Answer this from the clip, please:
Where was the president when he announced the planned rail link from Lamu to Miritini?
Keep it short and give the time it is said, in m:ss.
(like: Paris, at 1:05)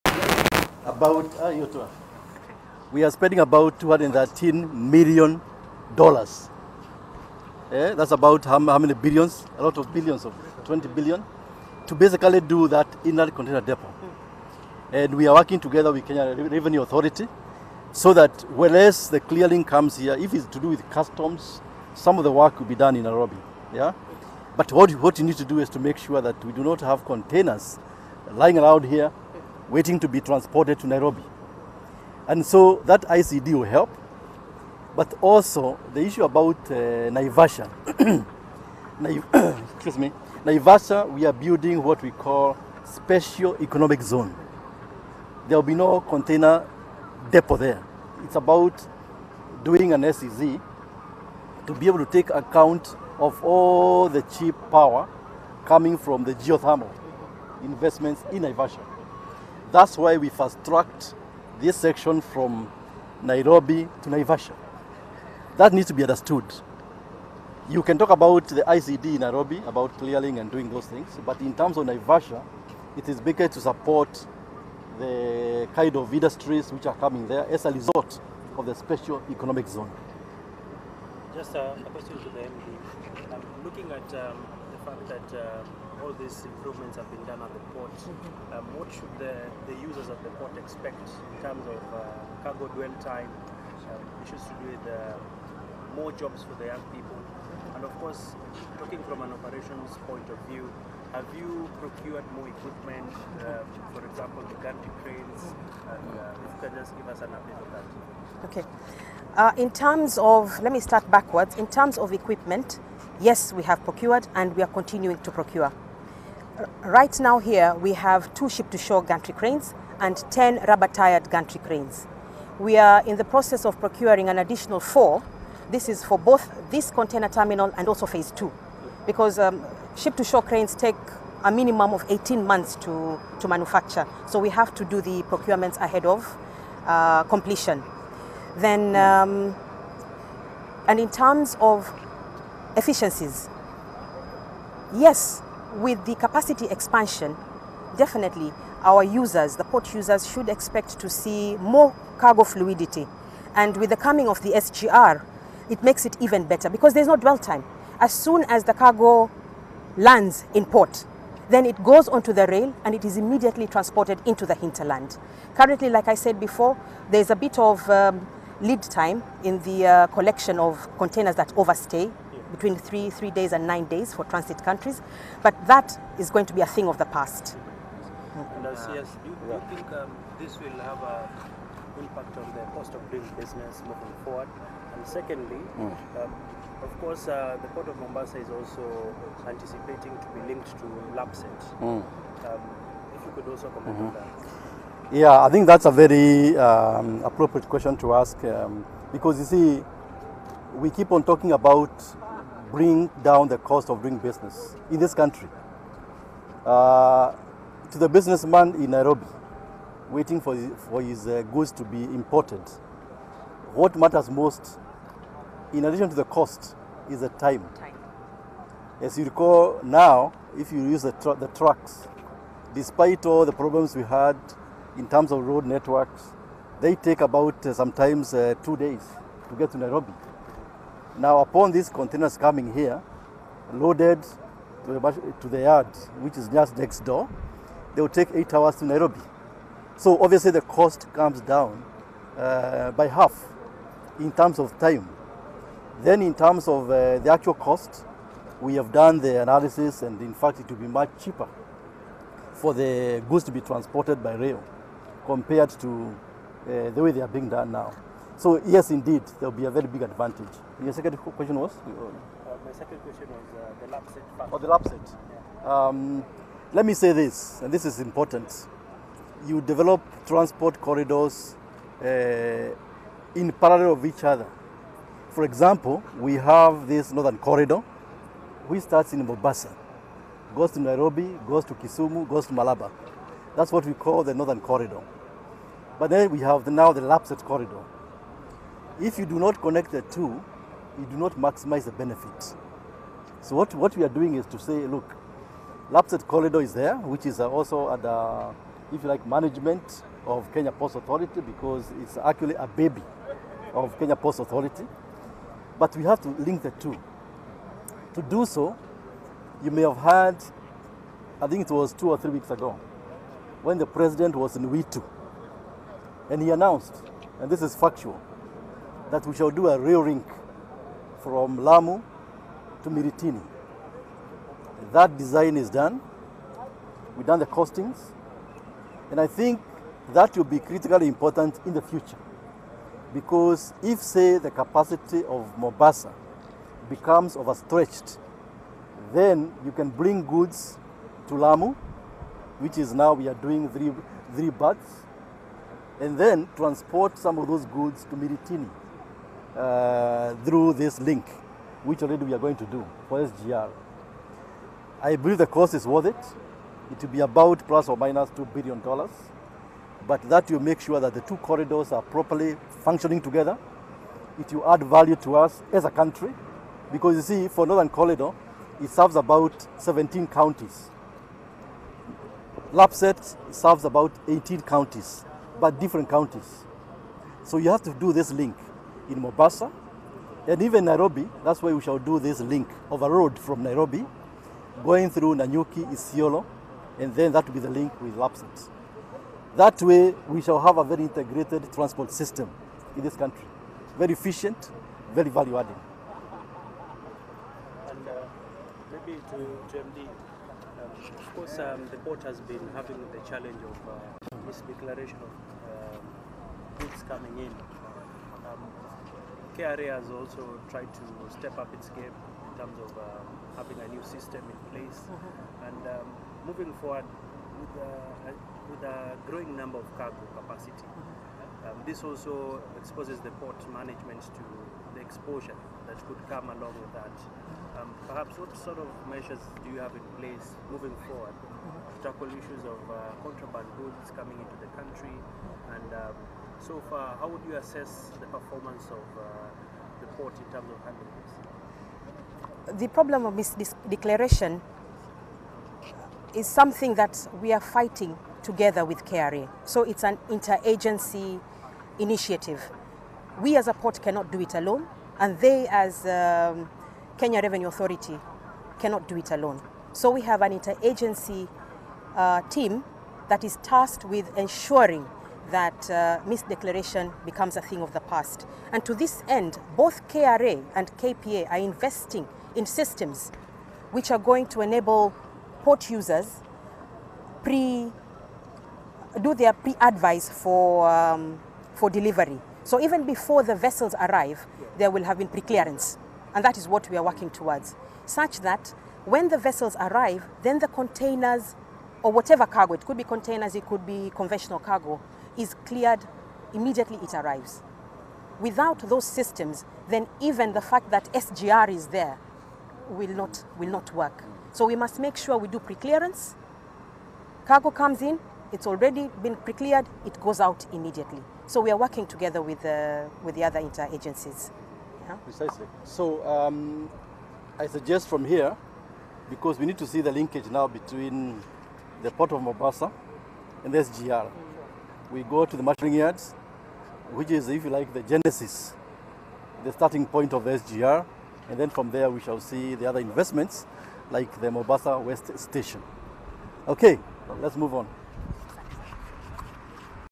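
Witu, at 5:14.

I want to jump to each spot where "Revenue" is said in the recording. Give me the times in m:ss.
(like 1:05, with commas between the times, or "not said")
0:16, 7:37.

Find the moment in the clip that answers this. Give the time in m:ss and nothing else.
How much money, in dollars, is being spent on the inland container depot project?
0:03.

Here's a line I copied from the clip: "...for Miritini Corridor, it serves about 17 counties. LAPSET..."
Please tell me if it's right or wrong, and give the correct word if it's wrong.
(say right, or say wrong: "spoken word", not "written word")
wrong: "Northern", not "Miritini".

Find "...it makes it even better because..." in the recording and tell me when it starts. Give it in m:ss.
2:35.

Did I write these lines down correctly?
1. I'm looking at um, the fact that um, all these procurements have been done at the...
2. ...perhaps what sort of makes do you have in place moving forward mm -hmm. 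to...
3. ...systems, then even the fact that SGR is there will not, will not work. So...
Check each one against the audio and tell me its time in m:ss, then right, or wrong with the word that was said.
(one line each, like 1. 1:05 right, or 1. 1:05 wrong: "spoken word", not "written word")
1. 1:23 wrong: "improvements", not "procurements"
2. 7:08 wrong: "measures", not "makes"
3. 8:19 right.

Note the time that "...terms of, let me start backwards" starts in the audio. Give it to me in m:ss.
1:49.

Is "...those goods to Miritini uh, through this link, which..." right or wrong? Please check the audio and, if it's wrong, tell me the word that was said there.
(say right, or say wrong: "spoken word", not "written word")
right.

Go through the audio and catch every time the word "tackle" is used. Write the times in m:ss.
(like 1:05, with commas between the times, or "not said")
7:12.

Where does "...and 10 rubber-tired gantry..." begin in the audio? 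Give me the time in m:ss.
1:59.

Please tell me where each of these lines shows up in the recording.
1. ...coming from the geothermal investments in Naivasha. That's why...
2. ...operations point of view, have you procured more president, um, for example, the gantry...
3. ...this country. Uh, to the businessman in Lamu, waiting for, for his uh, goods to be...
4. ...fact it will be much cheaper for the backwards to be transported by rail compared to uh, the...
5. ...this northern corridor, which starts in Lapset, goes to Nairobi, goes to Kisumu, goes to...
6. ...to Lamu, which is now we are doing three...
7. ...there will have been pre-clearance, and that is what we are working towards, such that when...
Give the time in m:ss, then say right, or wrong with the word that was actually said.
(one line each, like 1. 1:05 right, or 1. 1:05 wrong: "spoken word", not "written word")
1. 0:55 right
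2. 1:39 wrong: "equipment", not "president"
3. 3:24 wrong: "Nairobi", not "Lamu"
4. 4:10 wrong: "goods", not "backwards"
5. 4:36 wrong: "Mombasa", not "Lapset"
6. 5:41 right
7. 8:04 right.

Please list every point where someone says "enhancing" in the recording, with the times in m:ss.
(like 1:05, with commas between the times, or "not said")
not said.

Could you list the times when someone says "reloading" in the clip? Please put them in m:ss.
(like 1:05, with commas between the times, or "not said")
not said.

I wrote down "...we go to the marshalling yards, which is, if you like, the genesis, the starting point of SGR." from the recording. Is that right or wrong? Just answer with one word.
right.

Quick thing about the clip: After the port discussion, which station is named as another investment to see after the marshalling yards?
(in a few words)
Mombasa West Station.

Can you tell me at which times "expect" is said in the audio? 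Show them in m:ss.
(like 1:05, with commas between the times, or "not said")
1:30, 2:30.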